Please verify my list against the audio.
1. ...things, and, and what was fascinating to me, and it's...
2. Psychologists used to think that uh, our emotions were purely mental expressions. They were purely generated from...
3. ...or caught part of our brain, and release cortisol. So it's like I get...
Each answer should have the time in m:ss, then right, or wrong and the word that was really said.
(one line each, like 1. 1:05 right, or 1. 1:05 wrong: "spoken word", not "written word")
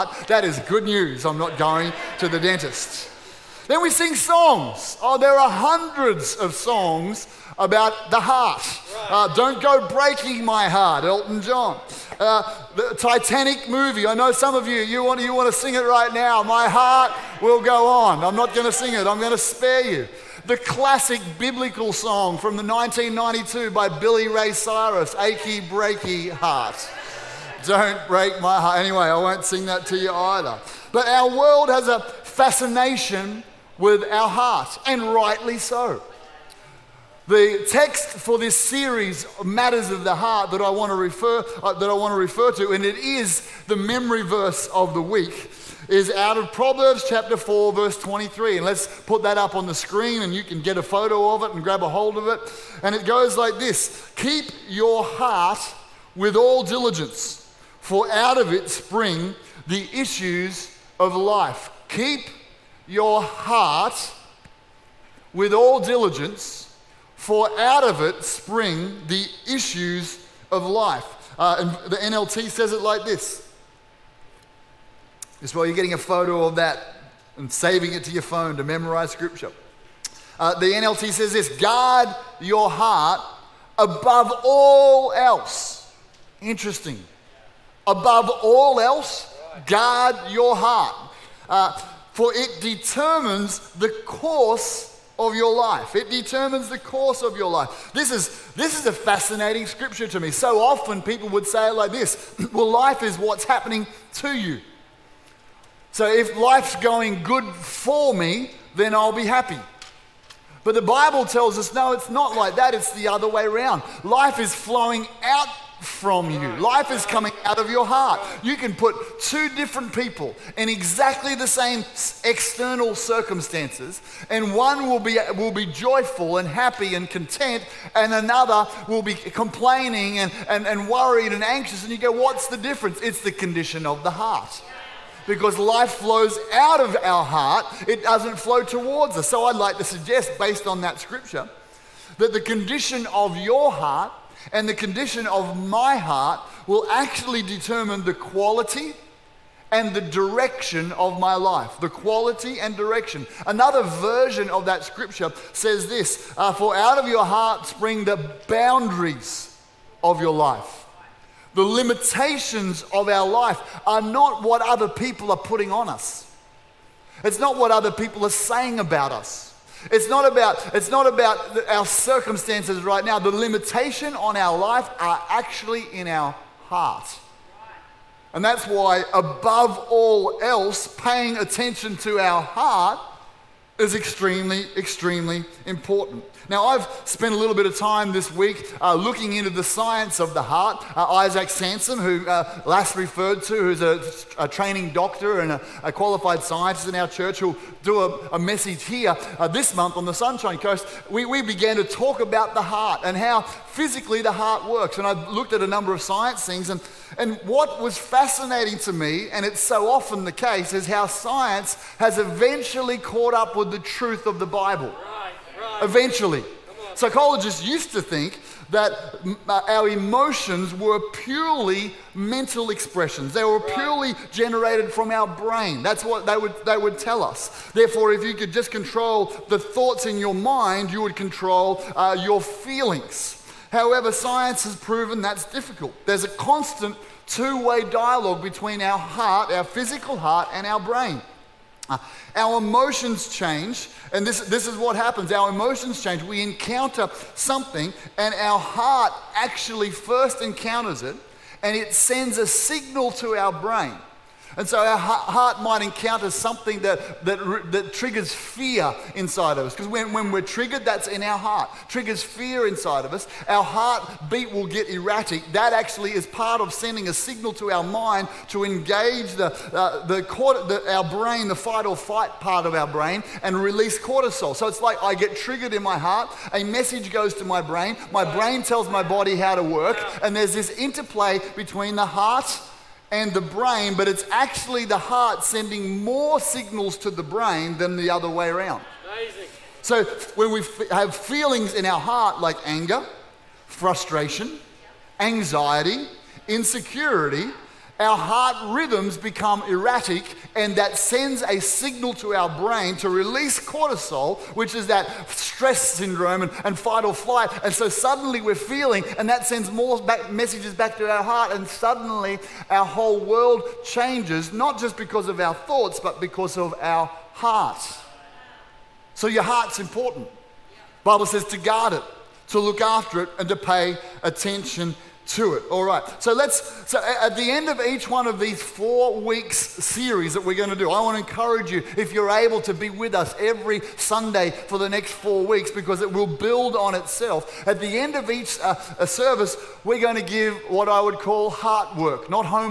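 1. 3:26 right
2. 3:36 right
3. 4:31 wrong: "fight", not "caught".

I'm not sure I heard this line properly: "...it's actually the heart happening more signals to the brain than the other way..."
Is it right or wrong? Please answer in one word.
wrong.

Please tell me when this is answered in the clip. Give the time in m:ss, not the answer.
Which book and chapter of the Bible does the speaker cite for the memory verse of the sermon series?
0:46.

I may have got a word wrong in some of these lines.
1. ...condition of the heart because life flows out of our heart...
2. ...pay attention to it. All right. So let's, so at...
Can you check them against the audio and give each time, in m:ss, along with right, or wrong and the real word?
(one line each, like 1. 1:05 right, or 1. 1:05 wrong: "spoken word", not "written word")
1. 2:13 right
2. 5:23 right.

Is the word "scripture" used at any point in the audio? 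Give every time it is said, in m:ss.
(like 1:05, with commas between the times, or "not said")
1:19, 1:39, 2:20, 2:34.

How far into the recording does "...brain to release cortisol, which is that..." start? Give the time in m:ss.
5:02.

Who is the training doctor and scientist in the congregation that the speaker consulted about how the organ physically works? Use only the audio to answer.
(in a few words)
Isaac Sansom.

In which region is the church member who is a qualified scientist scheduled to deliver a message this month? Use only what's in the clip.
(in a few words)
Sunshine Coast.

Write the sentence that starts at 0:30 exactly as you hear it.
But our world has a fascination with our heart, and rightly so.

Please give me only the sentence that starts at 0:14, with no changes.
I know some of you, you want, you want to sing it right now.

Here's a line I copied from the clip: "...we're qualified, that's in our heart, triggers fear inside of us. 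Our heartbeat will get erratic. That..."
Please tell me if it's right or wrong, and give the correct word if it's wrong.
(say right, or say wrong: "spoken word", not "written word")
wrong: "triggered", not "qualified".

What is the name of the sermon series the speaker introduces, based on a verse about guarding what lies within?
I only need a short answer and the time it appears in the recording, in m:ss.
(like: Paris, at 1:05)
Matters of the Heart, at 0:39.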